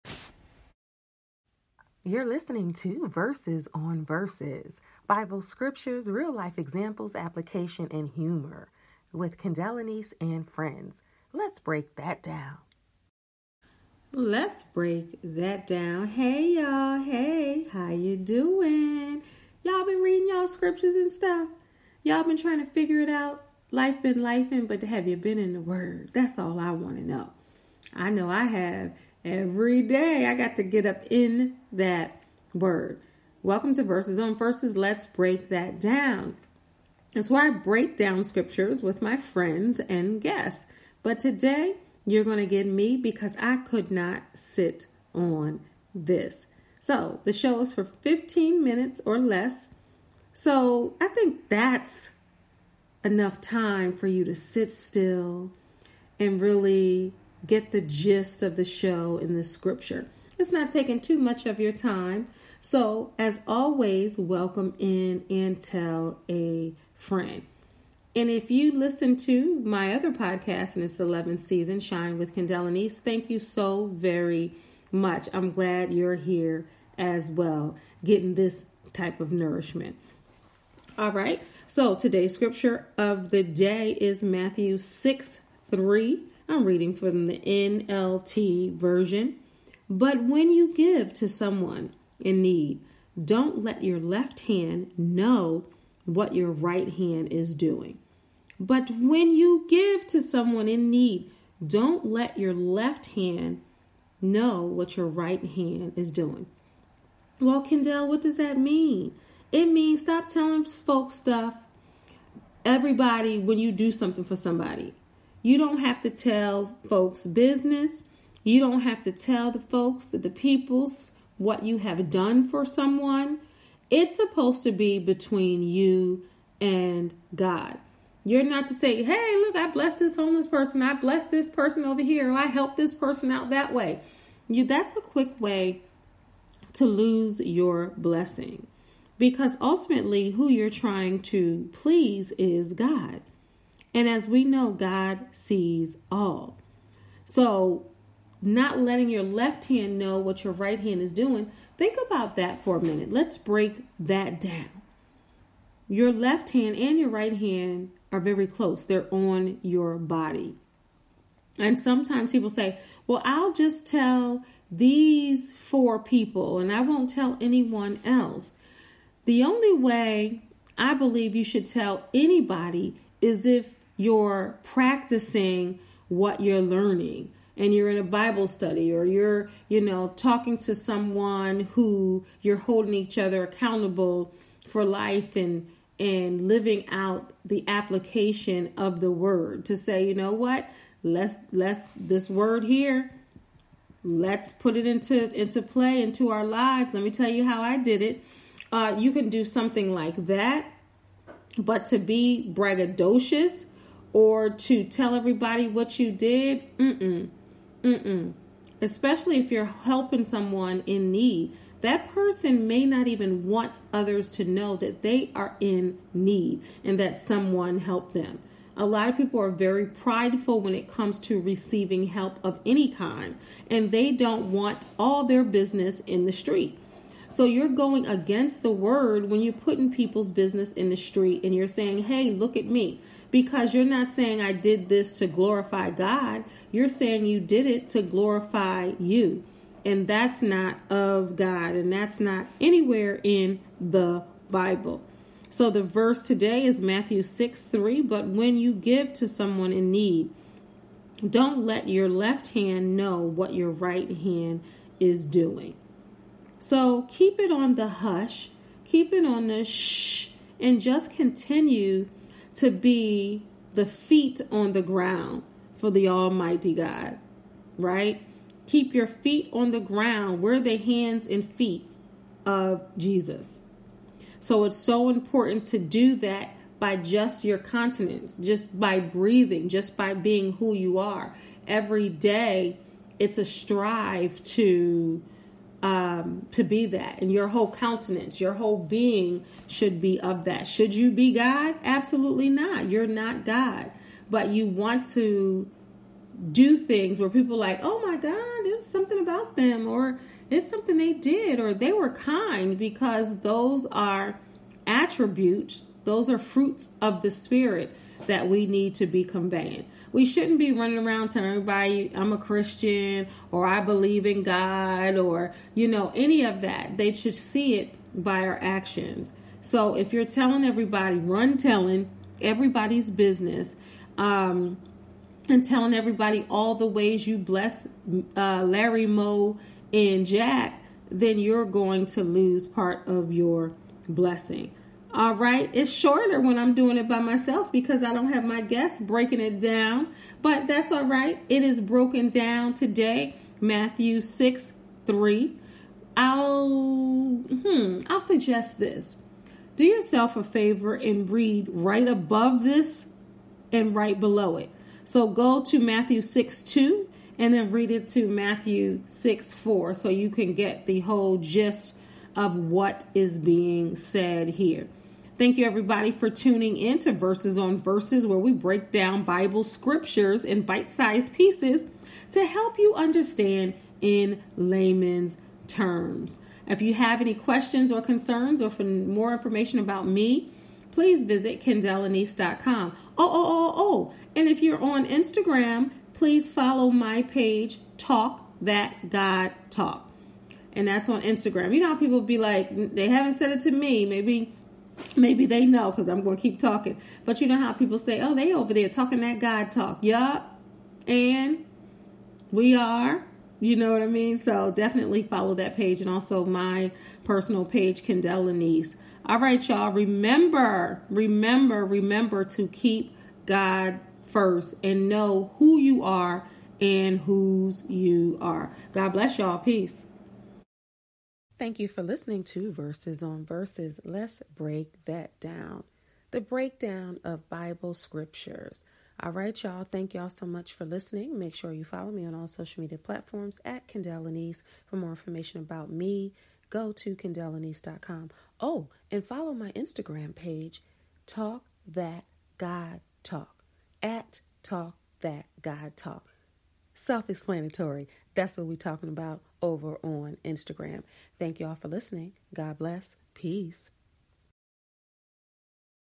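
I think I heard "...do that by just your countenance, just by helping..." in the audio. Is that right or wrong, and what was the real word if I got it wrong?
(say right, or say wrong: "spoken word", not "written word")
wrong: "breathing", not "helping".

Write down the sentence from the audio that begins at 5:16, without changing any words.
They should see it by our actions.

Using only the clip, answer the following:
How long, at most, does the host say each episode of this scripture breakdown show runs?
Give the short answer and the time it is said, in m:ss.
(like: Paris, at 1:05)
15 minutes, at 0:47.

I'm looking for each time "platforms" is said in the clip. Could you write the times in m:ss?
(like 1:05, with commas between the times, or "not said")
7:12.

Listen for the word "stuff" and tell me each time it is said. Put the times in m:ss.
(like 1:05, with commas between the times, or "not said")
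0:21, 1:51.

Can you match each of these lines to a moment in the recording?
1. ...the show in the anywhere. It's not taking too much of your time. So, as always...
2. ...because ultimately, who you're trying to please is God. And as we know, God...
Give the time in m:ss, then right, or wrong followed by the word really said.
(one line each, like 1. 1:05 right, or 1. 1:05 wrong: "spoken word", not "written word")
1. 0:58 wrong: "scripture", not "anywhere"
2. 2:19 right.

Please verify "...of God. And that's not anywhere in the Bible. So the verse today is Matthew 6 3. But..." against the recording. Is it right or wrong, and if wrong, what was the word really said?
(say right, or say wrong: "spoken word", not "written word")
right.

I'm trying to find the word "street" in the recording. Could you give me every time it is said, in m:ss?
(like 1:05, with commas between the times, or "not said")
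3:46, 3:50.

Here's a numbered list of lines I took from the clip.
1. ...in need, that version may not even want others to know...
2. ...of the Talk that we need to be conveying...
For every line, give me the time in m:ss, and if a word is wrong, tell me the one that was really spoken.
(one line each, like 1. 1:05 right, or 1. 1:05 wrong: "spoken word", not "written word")
1. 3:30 wrong: "person", not "version"
2. 5:07 wrong: "Spirit", not "Talk".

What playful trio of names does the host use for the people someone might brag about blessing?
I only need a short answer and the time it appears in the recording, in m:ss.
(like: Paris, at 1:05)
Larry, Moe, and Jack, at 5:28.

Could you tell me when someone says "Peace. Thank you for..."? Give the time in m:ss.
6:59.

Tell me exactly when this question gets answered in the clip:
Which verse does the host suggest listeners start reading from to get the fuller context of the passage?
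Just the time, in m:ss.
5:55.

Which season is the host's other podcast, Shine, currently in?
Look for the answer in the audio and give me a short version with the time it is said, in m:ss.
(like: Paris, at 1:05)
11th, at 1:10.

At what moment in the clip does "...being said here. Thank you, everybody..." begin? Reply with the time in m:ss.
6:03.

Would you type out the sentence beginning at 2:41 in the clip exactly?
And sometimes people say, Well, I'll just tell these four people and I won't tell anyone else.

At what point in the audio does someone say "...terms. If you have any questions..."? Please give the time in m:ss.
6:15.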